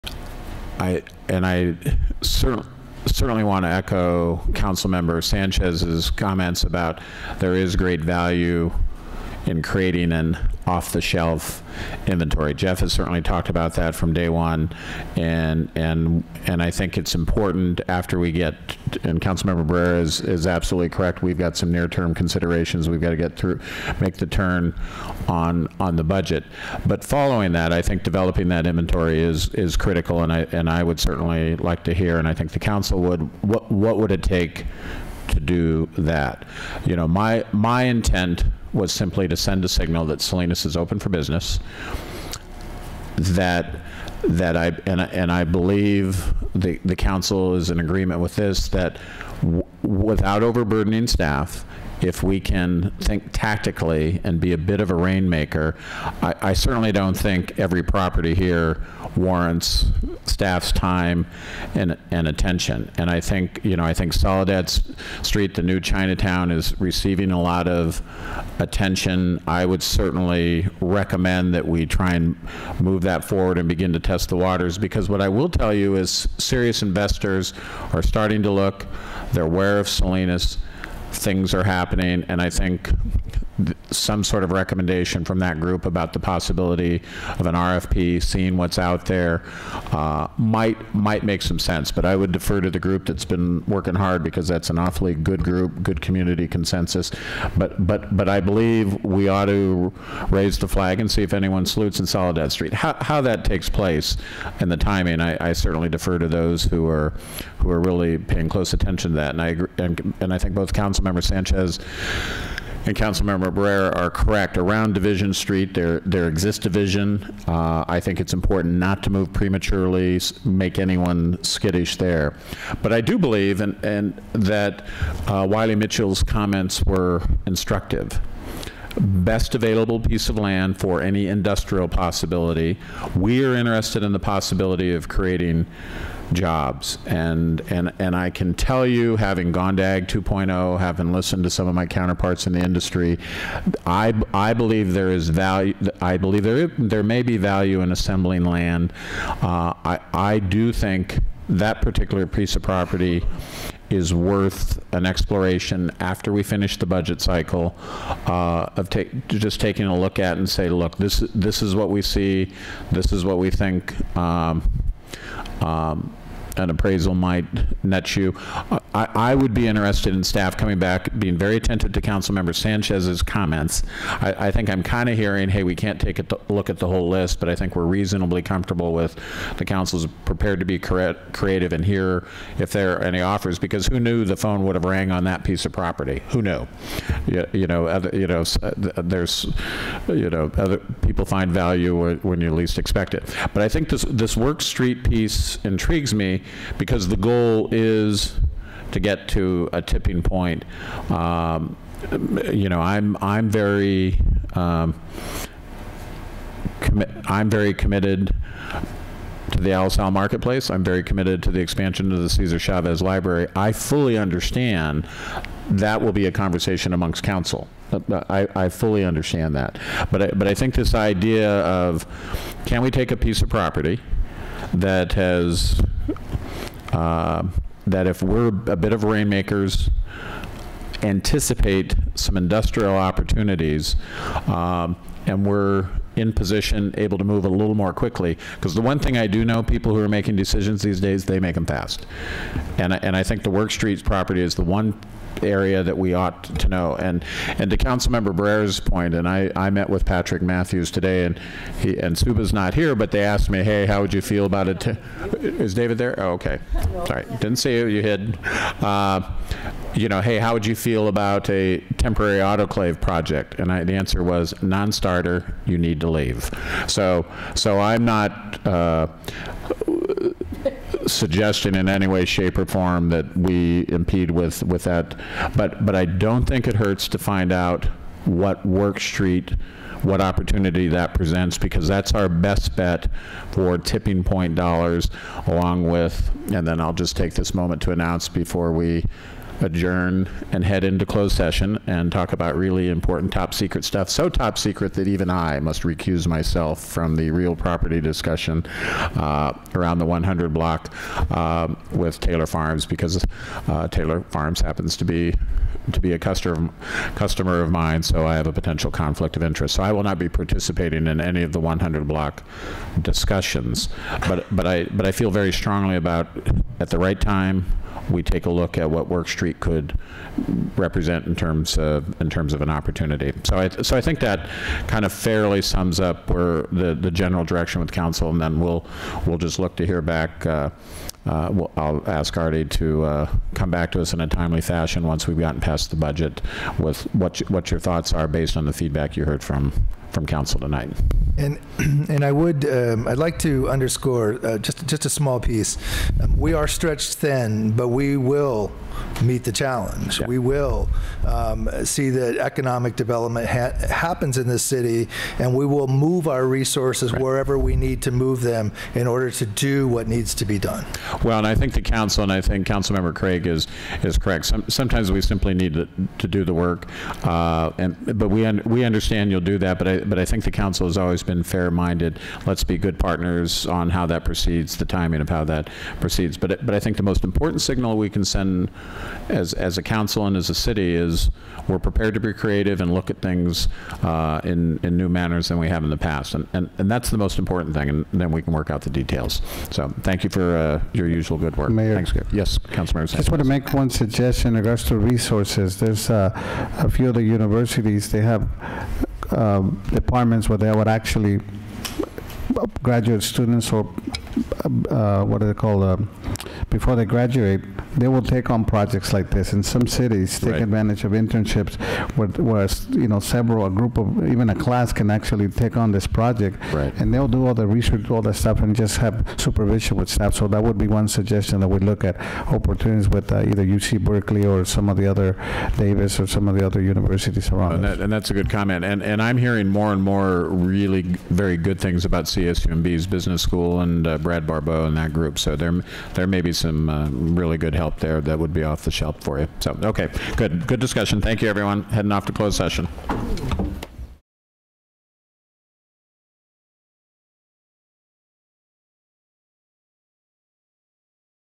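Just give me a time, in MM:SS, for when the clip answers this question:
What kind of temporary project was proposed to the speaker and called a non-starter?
04:21.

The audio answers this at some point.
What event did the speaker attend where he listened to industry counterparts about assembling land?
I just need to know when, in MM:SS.
02:19.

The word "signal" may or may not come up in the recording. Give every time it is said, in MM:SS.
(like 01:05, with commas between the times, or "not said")
00:39, 06:17.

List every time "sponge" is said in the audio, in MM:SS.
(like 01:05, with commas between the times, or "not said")
not said.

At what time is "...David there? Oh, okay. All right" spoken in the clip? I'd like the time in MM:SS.
04:15.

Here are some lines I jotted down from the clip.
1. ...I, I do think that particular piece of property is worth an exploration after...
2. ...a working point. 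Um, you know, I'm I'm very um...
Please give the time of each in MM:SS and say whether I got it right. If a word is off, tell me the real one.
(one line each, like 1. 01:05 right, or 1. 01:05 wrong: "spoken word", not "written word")
1. 02:29 right
2. 03:19 wrong: "tipping", not "working".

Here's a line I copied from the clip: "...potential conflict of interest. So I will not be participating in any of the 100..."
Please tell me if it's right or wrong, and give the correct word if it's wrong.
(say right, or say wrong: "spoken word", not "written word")
right.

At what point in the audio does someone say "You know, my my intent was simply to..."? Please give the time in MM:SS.
00:36.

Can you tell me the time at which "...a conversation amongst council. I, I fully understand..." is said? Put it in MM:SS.
03:36.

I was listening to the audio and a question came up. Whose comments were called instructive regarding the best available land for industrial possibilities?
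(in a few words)
Wiley Mitchell.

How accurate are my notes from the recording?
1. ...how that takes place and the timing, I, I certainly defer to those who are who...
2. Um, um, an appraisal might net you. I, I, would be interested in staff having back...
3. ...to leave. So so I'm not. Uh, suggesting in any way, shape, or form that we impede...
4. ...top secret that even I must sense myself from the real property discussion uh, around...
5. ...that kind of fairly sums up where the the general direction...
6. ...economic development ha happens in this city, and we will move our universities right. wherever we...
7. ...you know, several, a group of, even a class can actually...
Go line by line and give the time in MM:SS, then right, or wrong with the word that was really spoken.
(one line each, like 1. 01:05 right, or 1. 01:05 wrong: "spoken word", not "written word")
1. 01:43 right
2. 02:44 wrong: "coming", not "having"
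3. 04:26 right
4. 04:54 wrong: "recuse", not "sense"
5. 05:24 right
6. 05:52 wrong: "resources", not "universities"
7. 06:52 right.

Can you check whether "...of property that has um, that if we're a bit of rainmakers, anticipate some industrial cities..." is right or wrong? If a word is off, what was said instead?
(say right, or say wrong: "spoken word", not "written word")
wrong: "opportunities", not "cities".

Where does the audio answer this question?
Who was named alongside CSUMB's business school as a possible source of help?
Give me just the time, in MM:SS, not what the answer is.
07:14.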